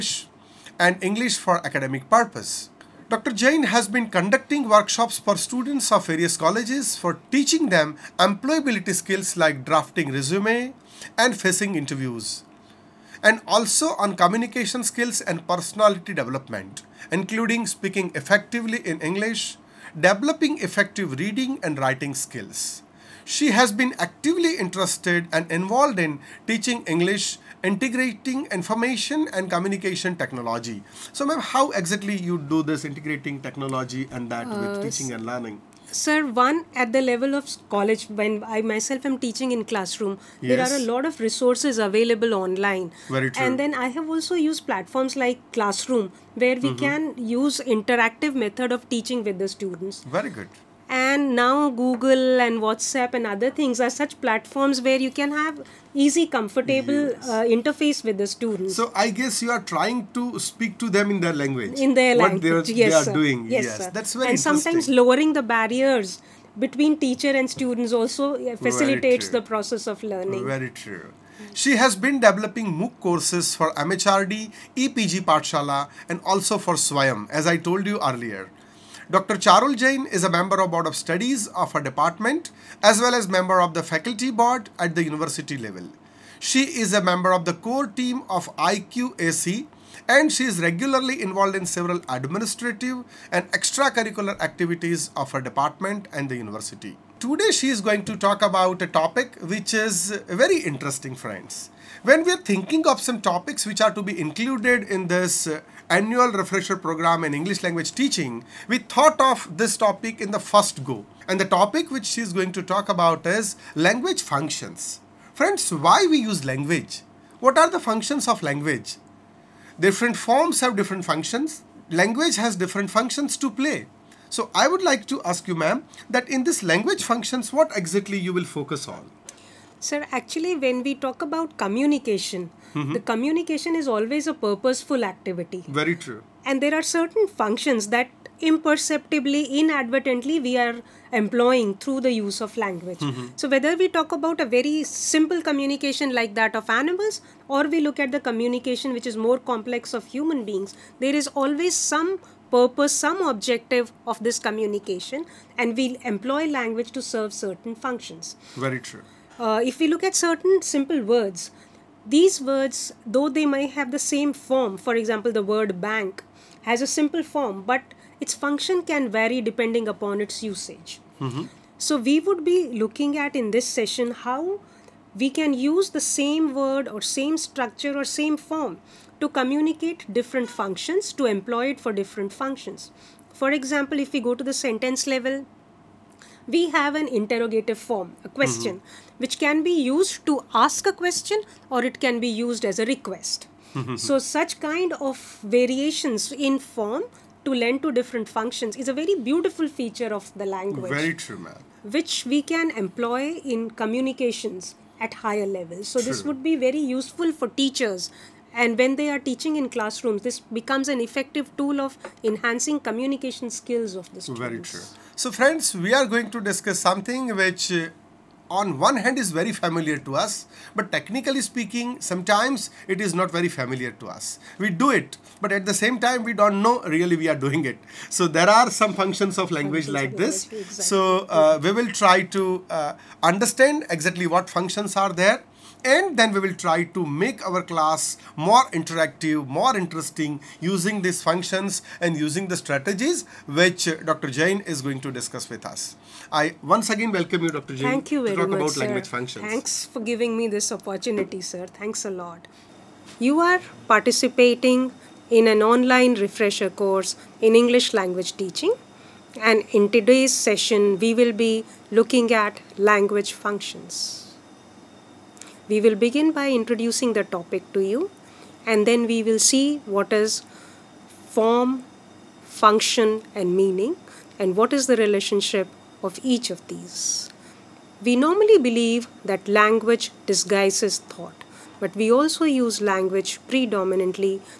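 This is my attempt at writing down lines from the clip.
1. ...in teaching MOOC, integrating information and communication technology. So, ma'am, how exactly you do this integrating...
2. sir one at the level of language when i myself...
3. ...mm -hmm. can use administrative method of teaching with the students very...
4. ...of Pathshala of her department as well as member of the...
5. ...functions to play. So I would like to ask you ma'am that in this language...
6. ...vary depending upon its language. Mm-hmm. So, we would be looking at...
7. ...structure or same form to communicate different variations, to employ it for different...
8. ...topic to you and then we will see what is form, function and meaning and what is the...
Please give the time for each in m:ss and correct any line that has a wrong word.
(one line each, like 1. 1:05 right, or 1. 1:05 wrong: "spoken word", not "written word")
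1. 0:25 wrong: "English", not "MOOC"
2. 0:35 wrong: "college", not "language"
3. 0:46 wrong: "interactive", not "administrative"
4. 1:20 wrong: "Studies", not "Pathshala"
5. 2:02 right
6. 2:49 wrong: "usage", not "language"
7. 2:57 wrong: "functions", not "variations"
8. 4:27 right.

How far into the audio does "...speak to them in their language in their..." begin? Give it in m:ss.
1:00.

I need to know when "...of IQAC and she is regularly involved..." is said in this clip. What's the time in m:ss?
1:28.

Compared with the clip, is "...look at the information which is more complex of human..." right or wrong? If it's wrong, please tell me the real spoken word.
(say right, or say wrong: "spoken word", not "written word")
wrong: "communication", not "information".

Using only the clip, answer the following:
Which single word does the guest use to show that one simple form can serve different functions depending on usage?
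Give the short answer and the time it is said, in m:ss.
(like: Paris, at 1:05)
bank, at 2:45.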